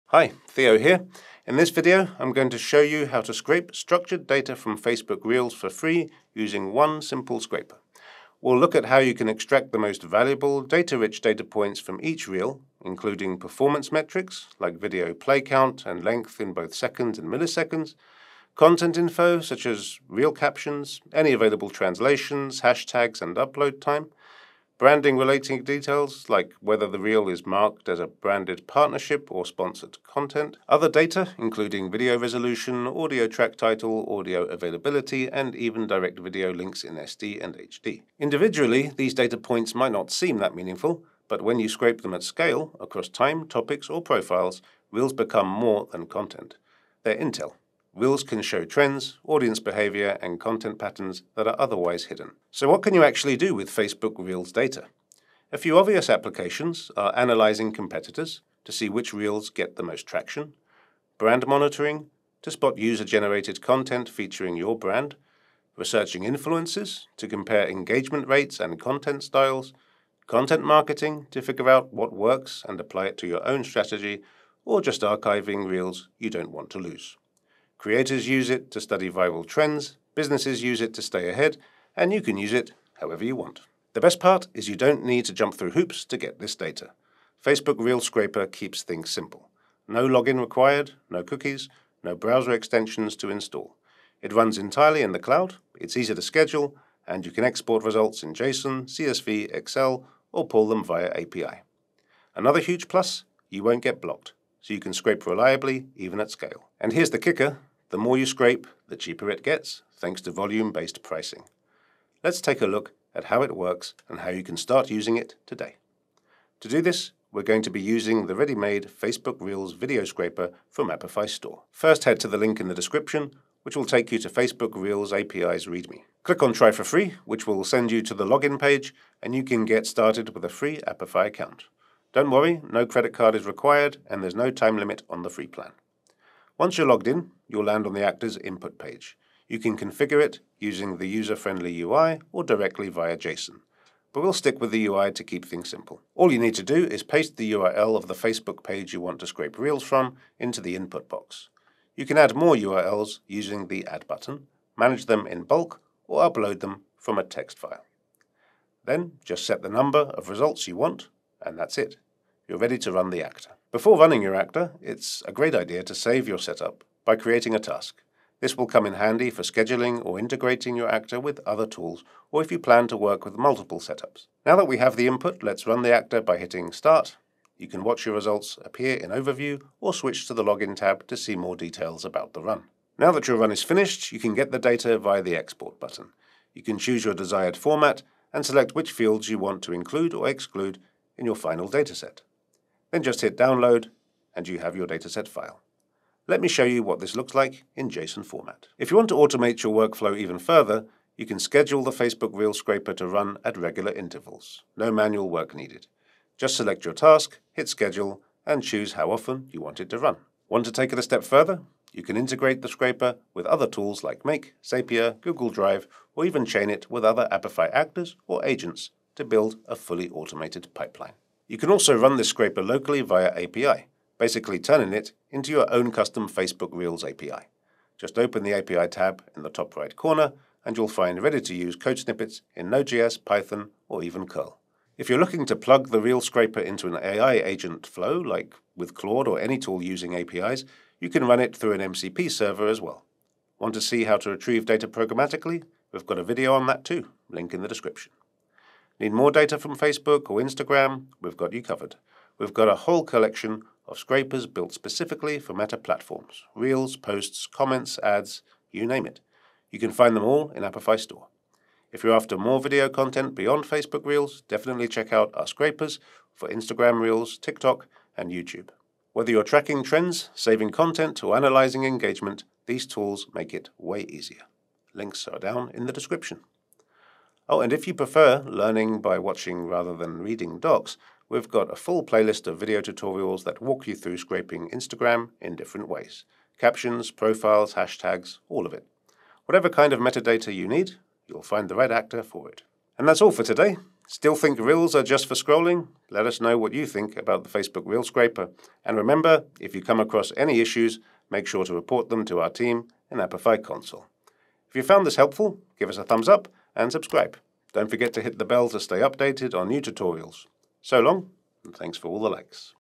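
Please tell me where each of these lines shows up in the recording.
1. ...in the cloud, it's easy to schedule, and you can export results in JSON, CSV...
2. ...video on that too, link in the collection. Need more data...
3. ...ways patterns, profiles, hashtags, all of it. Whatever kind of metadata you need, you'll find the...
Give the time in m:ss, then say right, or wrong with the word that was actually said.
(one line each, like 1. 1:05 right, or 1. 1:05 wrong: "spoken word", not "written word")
1. 1:35 right
2. 4:06 wrong: "description", not "collection"
3. 4:45 wrong: "captions", not "patterns".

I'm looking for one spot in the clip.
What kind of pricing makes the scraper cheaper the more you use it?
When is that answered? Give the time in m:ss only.
1:50.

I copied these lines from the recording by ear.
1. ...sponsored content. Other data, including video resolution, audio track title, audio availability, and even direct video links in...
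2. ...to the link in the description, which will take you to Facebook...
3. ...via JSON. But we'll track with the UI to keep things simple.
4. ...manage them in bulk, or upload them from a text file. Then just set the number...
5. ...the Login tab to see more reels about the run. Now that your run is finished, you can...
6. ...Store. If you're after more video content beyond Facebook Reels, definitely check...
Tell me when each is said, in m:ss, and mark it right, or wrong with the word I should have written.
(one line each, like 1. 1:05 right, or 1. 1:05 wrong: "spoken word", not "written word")
1. 0:29 right
2. 2:02 right
3. 2:22 wrong: "stick", not "track"
4. 2:34 right
5. 3:00 wrong: "details", not "reels"
6. 4:20 right.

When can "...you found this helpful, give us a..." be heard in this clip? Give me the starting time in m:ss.
5:04.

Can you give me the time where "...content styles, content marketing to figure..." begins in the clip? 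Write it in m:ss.
1:08.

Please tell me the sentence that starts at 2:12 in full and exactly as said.
Don't worry, no credit card is required, and there's no time limit on the free plan.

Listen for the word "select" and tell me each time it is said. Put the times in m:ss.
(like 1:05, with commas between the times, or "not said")
3:08, 3:26.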